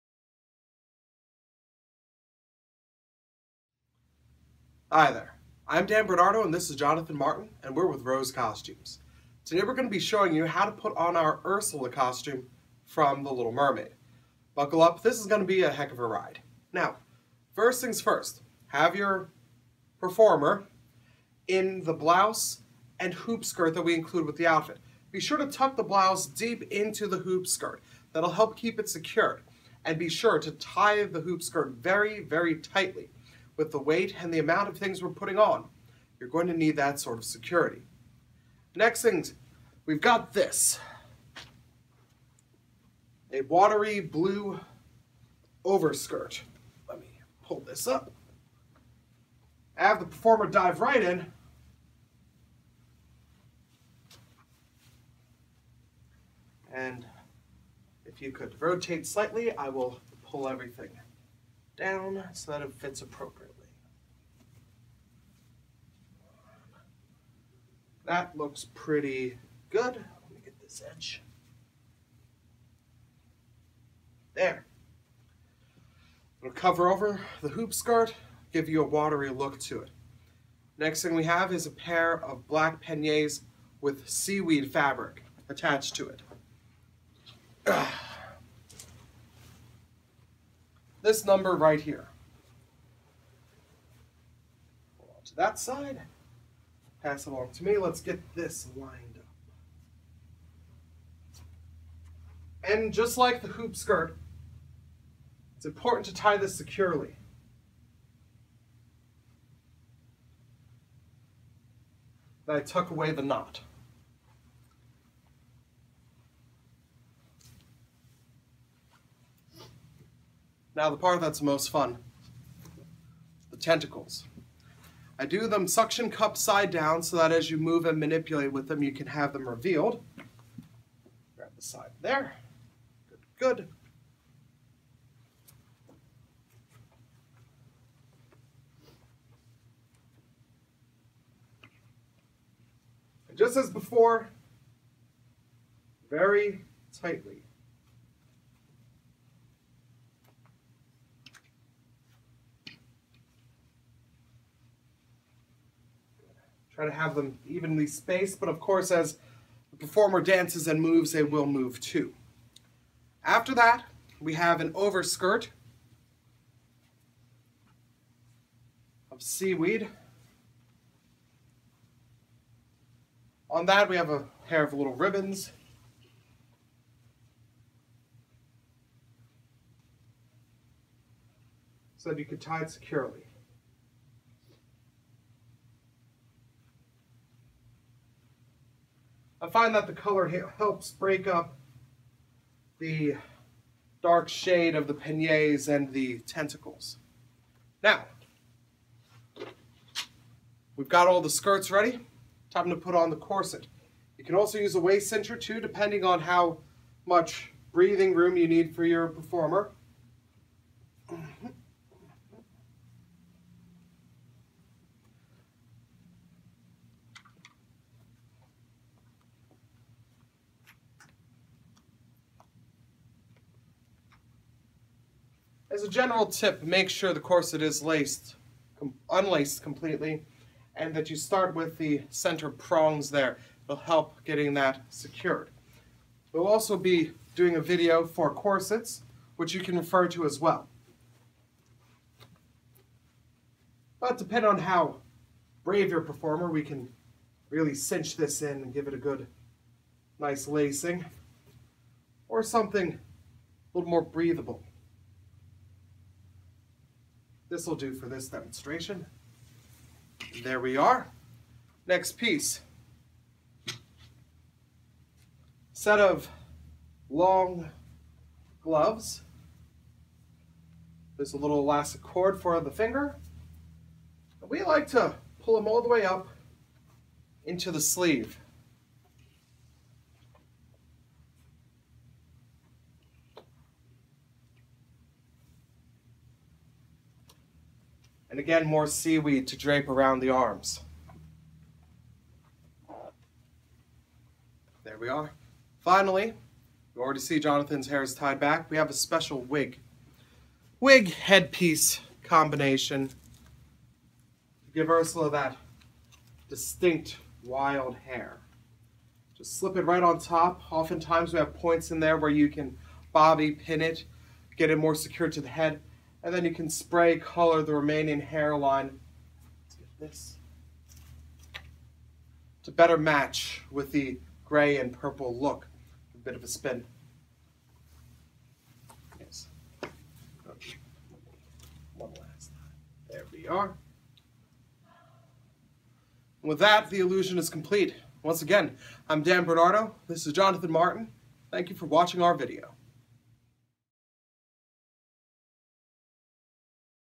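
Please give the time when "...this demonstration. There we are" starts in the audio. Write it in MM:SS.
04:18.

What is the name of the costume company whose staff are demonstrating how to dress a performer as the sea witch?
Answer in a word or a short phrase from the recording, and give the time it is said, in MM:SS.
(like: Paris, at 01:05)
Rose Costumes, at 00:08.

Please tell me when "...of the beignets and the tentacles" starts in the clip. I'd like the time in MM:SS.
03:14.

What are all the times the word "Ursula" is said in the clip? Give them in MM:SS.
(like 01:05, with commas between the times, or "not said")
00:11, 05:04.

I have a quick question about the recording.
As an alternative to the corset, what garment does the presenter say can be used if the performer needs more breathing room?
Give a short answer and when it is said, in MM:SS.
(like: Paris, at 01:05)
Waist cincher, at 03:24.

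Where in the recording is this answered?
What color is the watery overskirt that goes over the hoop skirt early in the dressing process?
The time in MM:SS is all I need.
00:43.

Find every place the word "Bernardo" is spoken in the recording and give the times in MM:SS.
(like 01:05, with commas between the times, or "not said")
00:06, 05:39.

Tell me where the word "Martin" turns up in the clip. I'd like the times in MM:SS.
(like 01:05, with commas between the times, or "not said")
00:07, 05:40.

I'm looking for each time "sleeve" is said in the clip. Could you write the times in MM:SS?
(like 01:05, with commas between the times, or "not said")
04:37.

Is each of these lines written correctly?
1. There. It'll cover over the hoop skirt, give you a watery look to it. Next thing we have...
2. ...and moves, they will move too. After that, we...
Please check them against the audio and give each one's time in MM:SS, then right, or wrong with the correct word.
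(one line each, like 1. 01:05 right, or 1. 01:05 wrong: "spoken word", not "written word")
1. 01:14 right
2. 02:40 right.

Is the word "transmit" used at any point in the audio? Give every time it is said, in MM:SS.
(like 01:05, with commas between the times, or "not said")
not said.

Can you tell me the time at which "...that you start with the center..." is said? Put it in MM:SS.
03:50.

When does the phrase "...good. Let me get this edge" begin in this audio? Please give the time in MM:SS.
01:09.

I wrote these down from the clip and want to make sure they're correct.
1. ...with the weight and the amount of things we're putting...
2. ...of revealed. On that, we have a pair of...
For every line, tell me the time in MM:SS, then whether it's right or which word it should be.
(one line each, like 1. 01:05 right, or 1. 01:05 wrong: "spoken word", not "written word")
1. 00:33 right
2. 02:49 wrong: "seaweed", not "revealed".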